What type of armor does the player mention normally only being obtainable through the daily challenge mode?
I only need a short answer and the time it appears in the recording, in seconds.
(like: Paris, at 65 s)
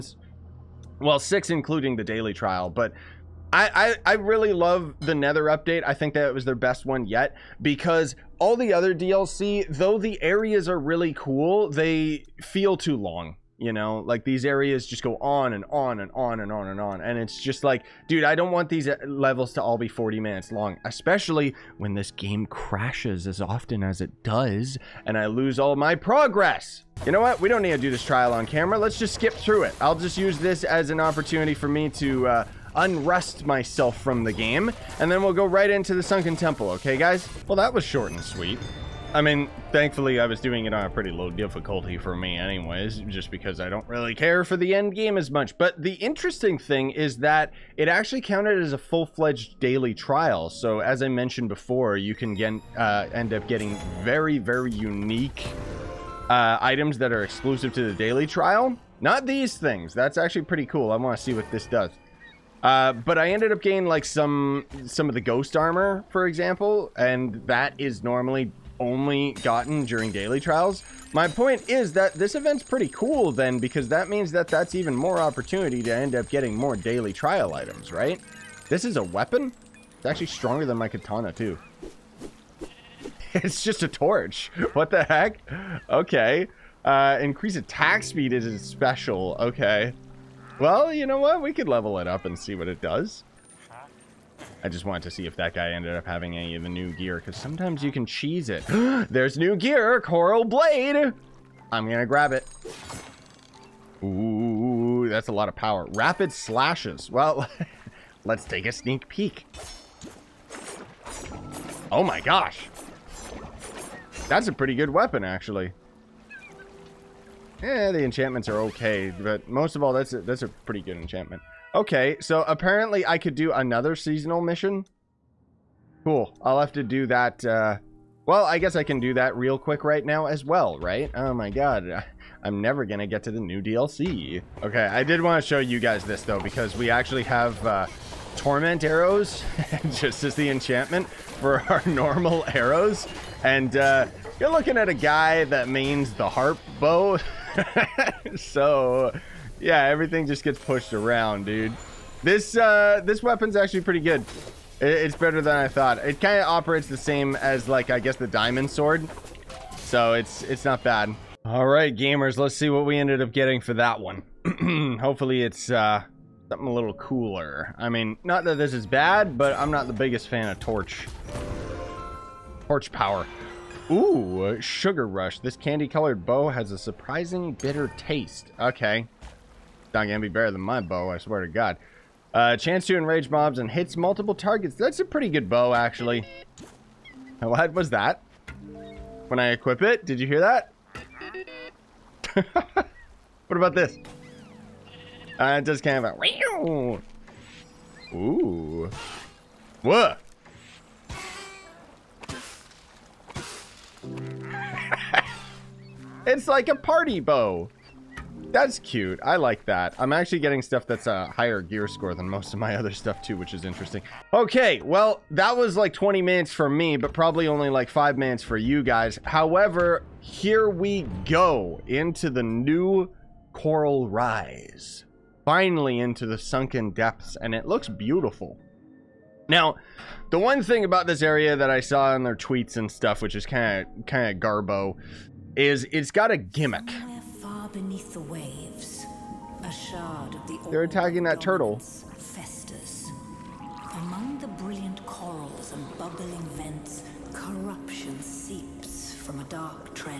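ghost armor, at 65 s.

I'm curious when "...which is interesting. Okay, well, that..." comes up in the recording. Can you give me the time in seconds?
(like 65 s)
213 s.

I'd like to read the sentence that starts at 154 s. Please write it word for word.
It, it's better than I thought.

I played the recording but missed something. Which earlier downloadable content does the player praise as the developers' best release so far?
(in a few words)
Nether update.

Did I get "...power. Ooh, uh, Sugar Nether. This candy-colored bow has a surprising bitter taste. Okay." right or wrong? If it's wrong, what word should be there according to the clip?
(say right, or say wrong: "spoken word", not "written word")
wrong: "Rush", not "Nether".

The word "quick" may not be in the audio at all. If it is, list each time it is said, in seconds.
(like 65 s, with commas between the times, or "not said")
129 s.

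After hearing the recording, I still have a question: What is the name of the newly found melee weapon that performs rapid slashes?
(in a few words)
Coral Blade.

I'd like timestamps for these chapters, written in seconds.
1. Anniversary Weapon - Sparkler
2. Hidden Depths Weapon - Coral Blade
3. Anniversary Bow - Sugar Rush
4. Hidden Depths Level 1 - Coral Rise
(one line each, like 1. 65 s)
1. 37 s
2. 93 s
3. 161 s
4. 213 s.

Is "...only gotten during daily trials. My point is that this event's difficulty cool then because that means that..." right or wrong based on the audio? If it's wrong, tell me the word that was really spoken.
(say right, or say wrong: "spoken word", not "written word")
wrong: "pretty", not "difficulty".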